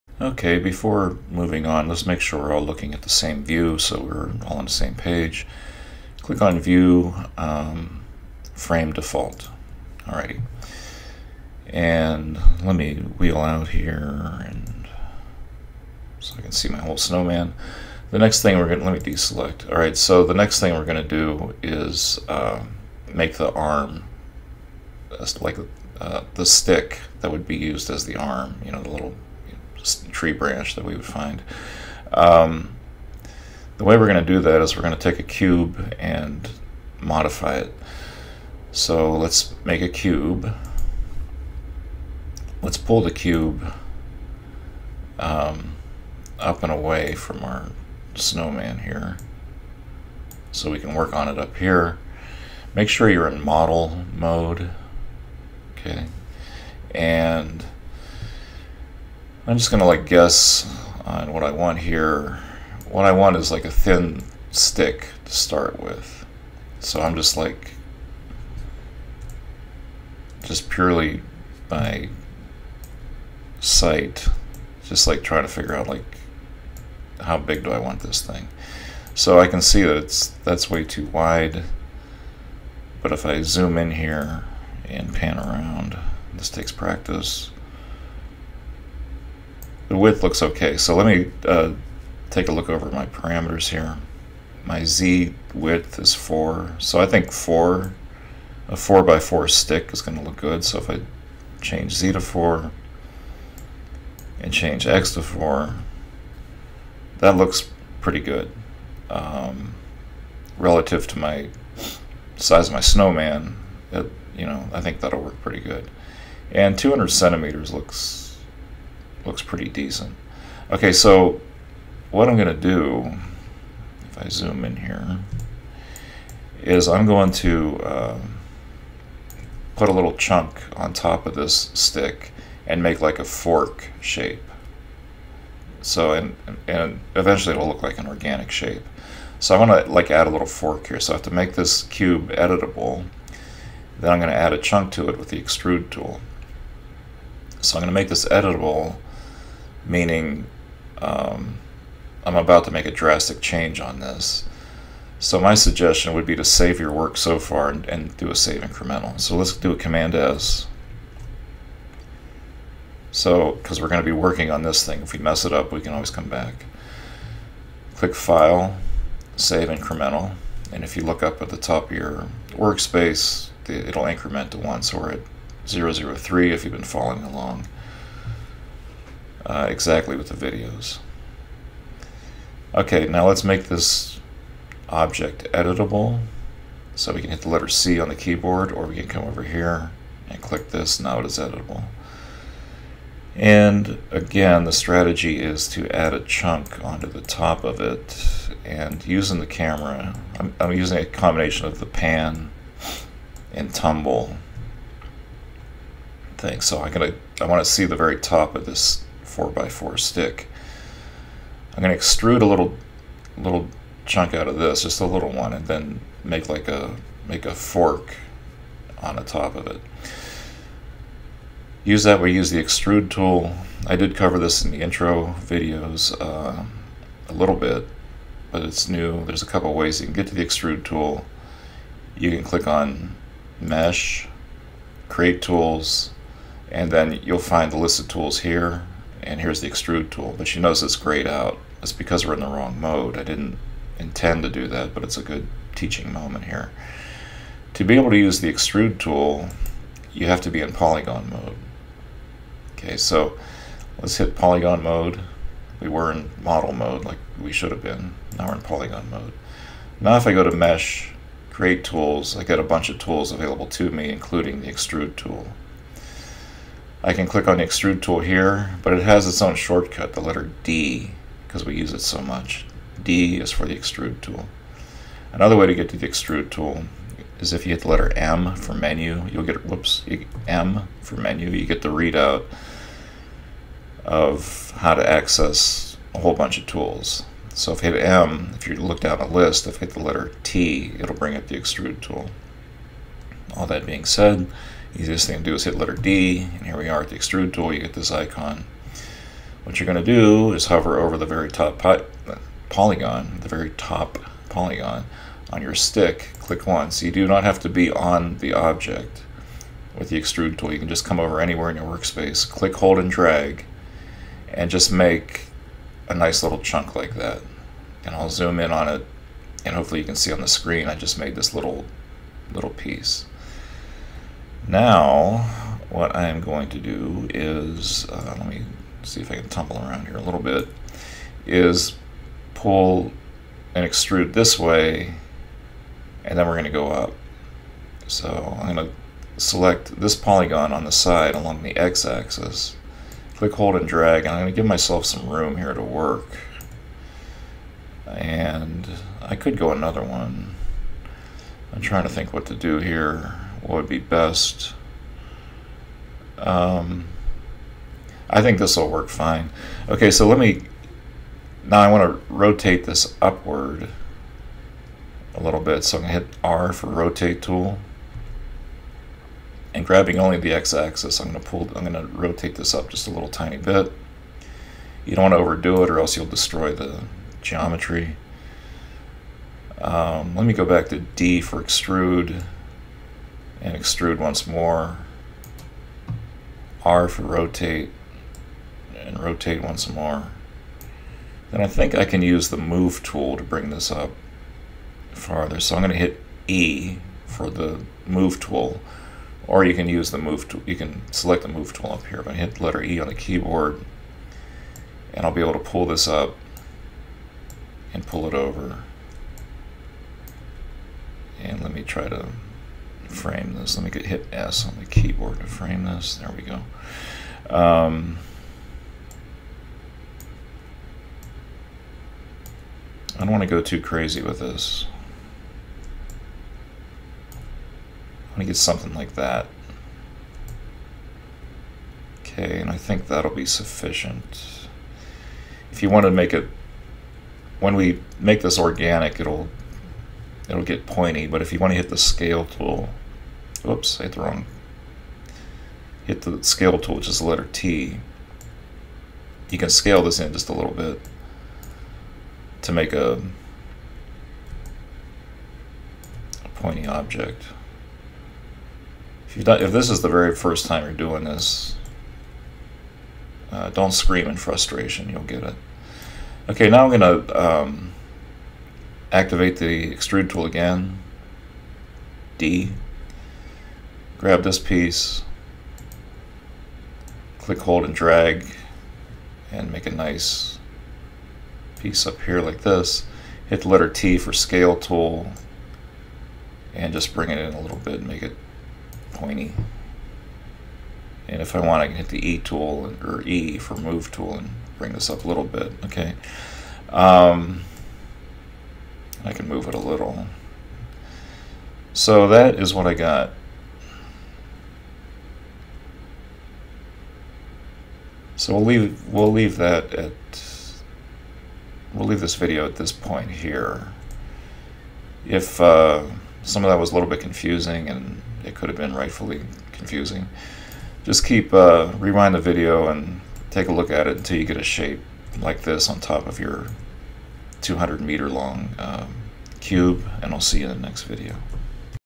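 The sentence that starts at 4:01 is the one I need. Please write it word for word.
It's because we're in the wrong mode.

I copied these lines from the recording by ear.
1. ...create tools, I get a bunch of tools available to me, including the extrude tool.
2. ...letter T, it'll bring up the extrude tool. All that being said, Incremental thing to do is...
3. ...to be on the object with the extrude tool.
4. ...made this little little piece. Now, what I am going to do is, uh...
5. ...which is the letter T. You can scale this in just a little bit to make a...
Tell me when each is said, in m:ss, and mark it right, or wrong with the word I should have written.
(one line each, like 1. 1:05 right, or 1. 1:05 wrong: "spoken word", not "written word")
1. 4:21 right
2. 4:50 wrong: "Easiest", not "Incremental"
3. 5:07 right
4. 5:21 right
5. 7:26 right.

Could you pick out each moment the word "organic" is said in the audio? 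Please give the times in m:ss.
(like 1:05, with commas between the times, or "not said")
2:18, 7:18.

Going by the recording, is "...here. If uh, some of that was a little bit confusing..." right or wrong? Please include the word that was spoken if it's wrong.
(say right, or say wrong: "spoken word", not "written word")
right.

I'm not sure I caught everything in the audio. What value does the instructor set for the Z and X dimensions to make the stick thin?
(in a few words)
4.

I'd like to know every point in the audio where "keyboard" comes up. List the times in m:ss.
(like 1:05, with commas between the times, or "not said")
3:08, 6:43, 6:54.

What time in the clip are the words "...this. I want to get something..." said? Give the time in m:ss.
7:04.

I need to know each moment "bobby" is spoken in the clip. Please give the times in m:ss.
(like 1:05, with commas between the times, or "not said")
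not said.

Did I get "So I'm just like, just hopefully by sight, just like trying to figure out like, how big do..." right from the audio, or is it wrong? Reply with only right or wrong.
wrong.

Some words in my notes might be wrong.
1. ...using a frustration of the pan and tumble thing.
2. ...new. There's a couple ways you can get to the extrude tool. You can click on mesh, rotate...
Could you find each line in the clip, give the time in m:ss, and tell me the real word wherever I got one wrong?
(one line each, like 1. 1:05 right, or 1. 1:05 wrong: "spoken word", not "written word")
1. 3:20 wrong: "combination", not "frustration"
2. 3:48 wrong: "create", not "rotate".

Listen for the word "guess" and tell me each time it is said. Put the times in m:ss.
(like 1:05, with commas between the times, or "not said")
1:00.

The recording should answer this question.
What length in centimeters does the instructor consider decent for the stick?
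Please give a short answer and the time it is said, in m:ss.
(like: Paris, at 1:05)
200, at 1:56.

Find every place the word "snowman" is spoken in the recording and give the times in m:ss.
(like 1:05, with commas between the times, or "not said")
0:16, 0:48, 1:52.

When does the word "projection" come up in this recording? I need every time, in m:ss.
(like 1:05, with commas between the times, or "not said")
not said.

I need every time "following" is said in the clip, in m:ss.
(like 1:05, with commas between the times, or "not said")
2:56.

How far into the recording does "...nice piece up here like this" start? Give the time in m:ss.
7:59.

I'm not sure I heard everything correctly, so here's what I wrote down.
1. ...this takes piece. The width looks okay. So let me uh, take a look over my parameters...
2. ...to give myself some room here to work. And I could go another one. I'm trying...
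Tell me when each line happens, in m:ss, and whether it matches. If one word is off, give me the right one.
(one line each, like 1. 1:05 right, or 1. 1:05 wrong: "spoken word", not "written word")
1. 1:26 wrong: "practice", not "piece"
2. 5:44 right.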